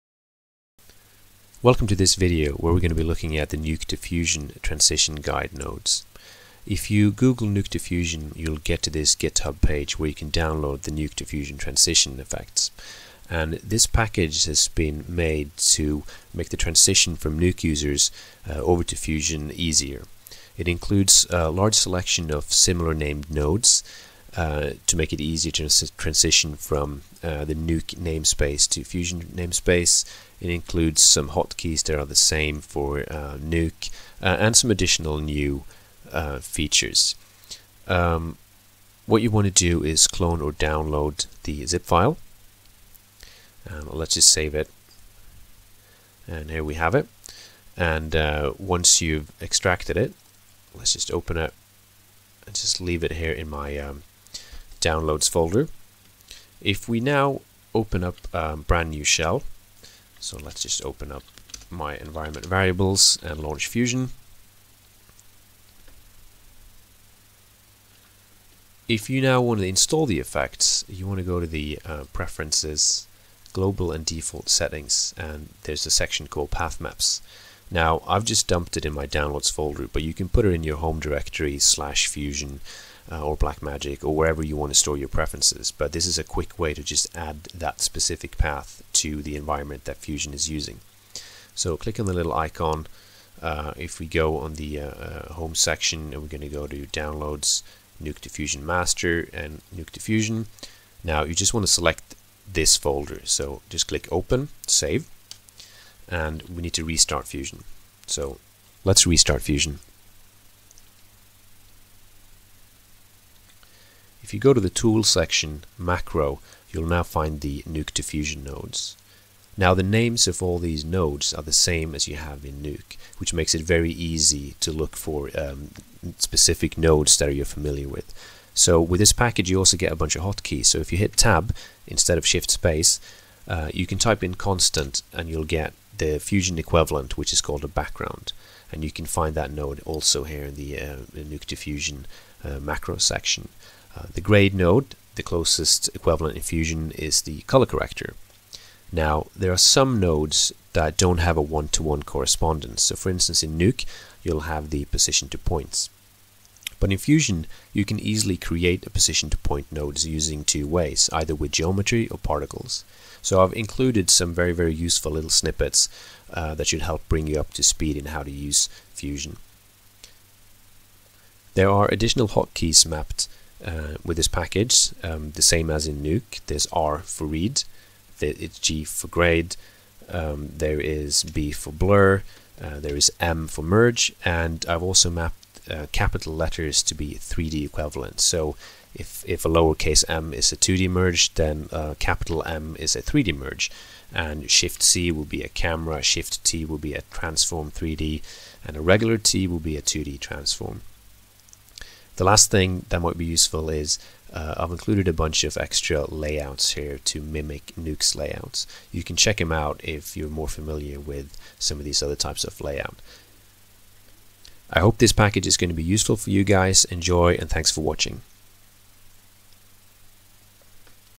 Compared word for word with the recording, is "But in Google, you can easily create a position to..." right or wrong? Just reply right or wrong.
wrong.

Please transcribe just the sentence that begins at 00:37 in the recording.
Um, what you want to do is clone or download the zip file.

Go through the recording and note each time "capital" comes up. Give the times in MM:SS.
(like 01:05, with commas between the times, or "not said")
03:05, 03:11.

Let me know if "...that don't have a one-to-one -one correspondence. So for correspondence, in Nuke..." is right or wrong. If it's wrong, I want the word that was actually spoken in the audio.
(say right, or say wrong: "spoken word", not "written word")
wrong: "instance", not "correspondence".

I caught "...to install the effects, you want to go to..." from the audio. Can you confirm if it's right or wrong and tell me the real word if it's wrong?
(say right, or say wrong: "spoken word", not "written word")
right.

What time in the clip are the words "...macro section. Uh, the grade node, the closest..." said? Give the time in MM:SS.
02:22.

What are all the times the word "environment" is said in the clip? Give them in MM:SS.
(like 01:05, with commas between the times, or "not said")
01:01, 01:29.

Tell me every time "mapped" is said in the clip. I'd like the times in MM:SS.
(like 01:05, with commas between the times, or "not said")
02:52, 03:05.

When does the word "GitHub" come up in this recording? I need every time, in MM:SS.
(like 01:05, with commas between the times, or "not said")
00:09.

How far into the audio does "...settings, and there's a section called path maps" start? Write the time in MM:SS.
01:14.